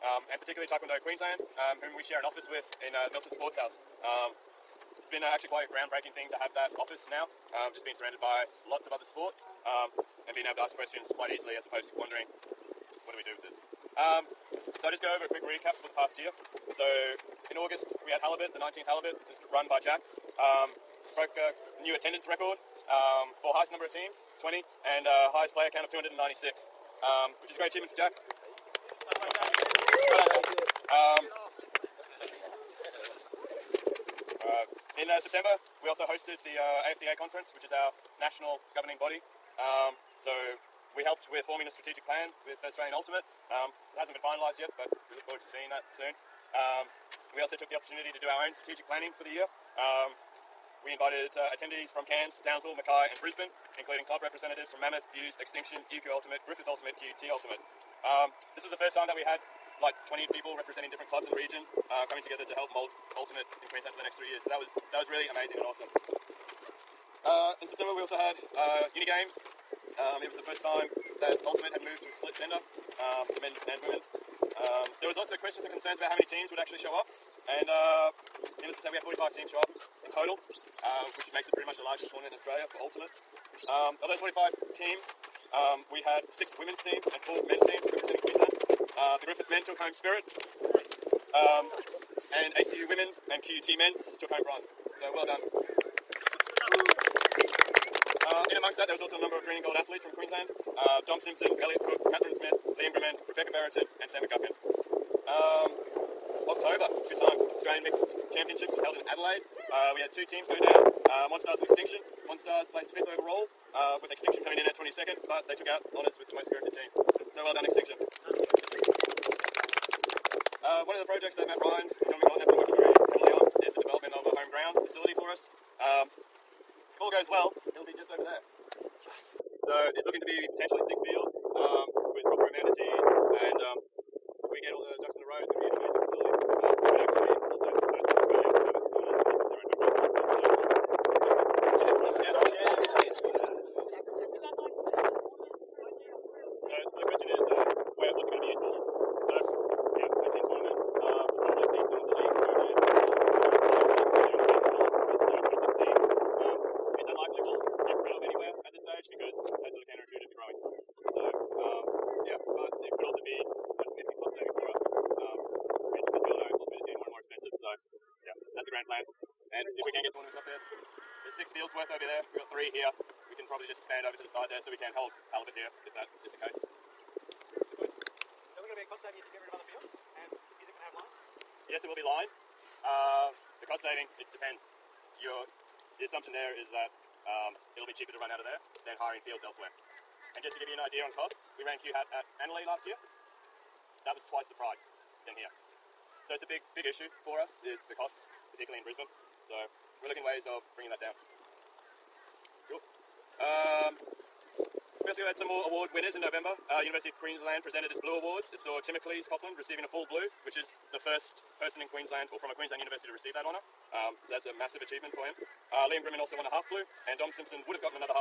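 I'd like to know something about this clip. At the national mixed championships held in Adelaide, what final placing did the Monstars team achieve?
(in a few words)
fifth.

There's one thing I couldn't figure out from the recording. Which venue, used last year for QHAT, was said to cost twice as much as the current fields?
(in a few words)
Annalee.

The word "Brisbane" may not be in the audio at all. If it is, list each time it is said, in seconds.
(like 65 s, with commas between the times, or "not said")
53 s, 198 s.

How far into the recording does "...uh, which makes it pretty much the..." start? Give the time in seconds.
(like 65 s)
80 s.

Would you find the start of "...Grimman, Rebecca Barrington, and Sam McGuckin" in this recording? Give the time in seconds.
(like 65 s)
102 s.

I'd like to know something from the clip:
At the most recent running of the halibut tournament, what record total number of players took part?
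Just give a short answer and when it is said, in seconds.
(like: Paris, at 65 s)
296, at 25 s.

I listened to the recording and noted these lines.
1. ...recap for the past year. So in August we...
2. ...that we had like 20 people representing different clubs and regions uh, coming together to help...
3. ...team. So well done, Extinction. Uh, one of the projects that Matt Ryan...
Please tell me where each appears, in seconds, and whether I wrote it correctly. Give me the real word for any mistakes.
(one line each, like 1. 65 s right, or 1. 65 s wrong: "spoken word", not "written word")
1. 15 s right
2. 59 s right
3. 116 s right.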